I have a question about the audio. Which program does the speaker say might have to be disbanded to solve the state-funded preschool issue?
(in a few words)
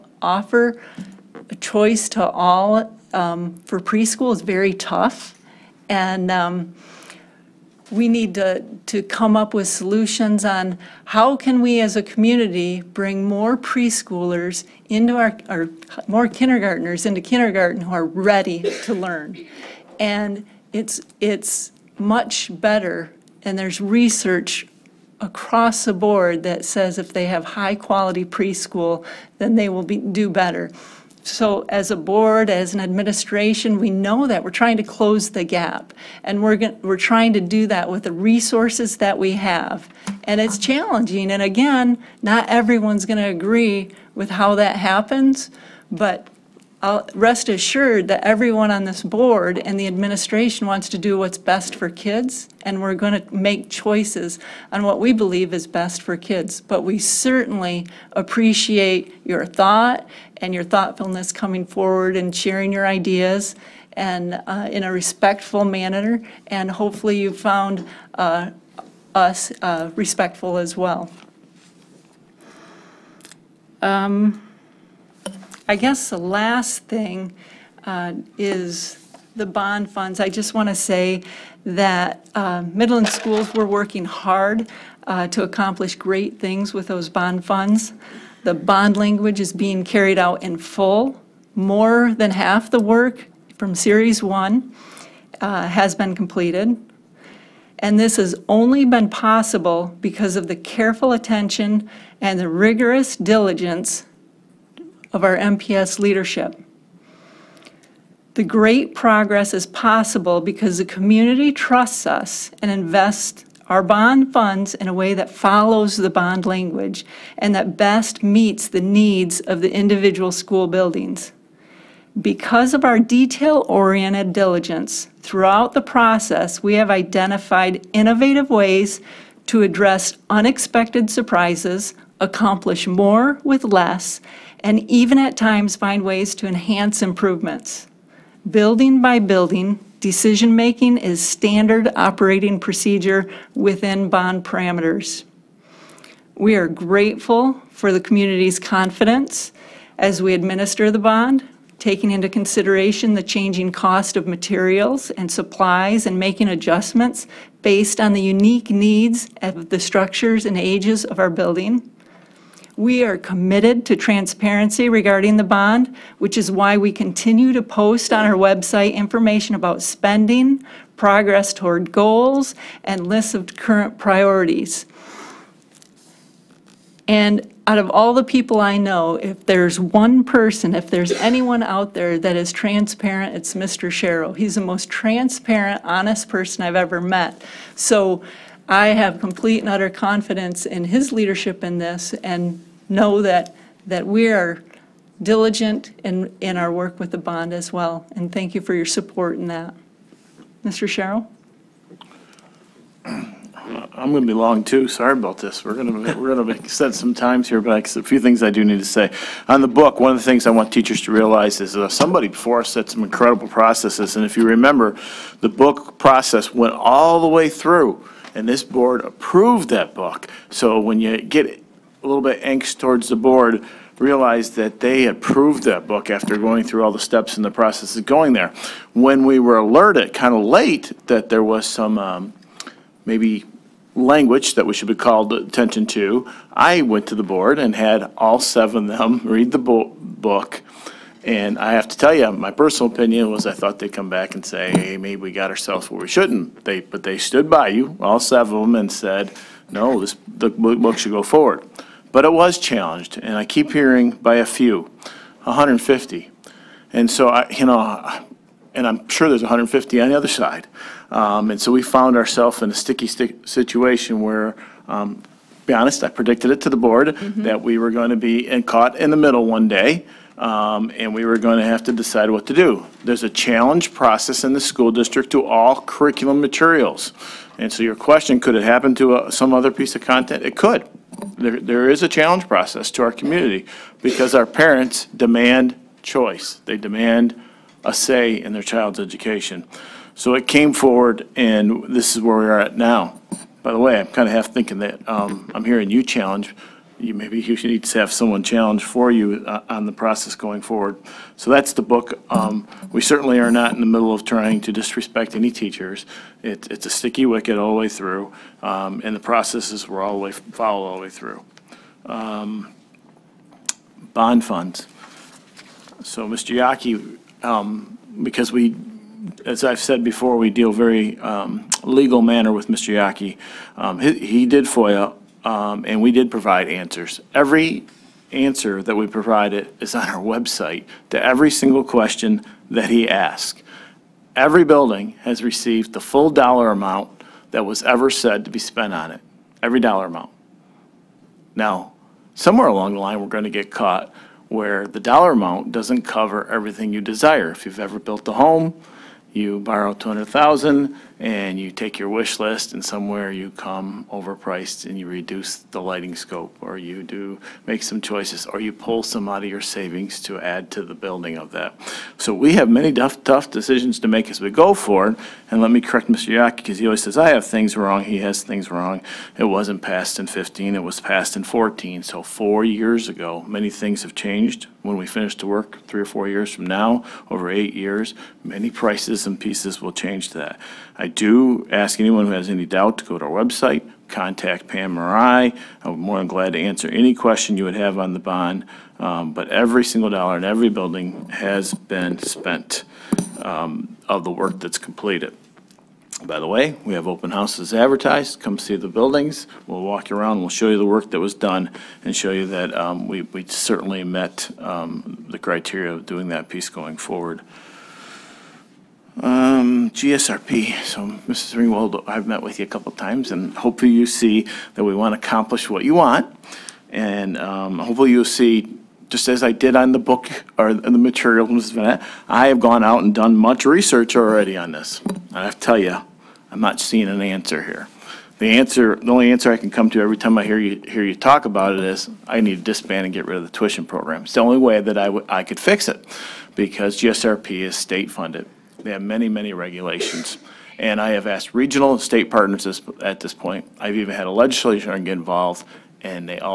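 the tuition program.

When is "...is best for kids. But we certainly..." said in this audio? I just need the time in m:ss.
0:55.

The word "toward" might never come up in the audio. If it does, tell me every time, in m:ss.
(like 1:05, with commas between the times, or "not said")
2:51, 3:42.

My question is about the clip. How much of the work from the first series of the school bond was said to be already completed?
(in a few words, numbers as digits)
More than half.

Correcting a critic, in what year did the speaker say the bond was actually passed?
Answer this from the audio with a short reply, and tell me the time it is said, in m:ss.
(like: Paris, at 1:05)
2014, at 6:11.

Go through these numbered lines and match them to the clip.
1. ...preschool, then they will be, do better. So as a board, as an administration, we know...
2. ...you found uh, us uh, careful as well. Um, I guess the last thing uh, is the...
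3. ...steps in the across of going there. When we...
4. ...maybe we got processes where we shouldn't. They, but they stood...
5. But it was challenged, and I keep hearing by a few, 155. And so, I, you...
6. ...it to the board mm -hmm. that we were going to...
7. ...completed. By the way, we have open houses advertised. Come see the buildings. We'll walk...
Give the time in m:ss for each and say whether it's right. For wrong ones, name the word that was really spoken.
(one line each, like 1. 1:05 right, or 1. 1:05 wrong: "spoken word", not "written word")
1. 0:28 right
2. 1:07 wrong: "respectful", not "careful"
3. 3:46 wrong: "process", not "across"
4. 4:04 wrong: "ourselves", not "processes"
5. 4:12 wrong: "150", not "155"
6. 4:26 right
7. 6:34 right.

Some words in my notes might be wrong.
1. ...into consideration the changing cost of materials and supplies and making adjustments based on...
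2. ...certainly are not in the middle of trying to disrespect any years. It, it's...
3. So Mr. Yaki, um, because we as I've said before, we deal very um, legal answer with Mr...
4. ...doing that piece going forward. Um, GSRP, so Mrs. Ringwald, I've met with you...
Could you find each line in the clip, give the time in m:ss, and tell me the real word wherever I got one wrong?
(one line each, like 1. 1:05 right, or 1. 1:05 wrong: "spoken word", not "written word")
1. 2:32 right
2. 5:03 wrong: "teachers", not "years"
3. 5:16 wrong: "manner", not "answer"
4. 6:46 right.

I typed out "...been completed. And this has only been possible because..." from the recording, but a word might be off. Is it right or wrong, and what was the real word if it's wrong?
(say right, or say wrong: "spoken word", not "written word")
right.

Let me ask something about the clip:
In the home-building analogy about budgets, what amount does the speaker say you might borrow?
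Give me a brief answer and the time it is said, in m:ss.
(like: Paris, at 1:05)
200,000, at 5:49.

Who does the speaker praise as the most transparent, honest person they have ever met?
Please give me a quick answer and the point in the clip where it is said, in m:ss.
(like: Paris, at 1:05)
Mr. Sharrow, at 3:03.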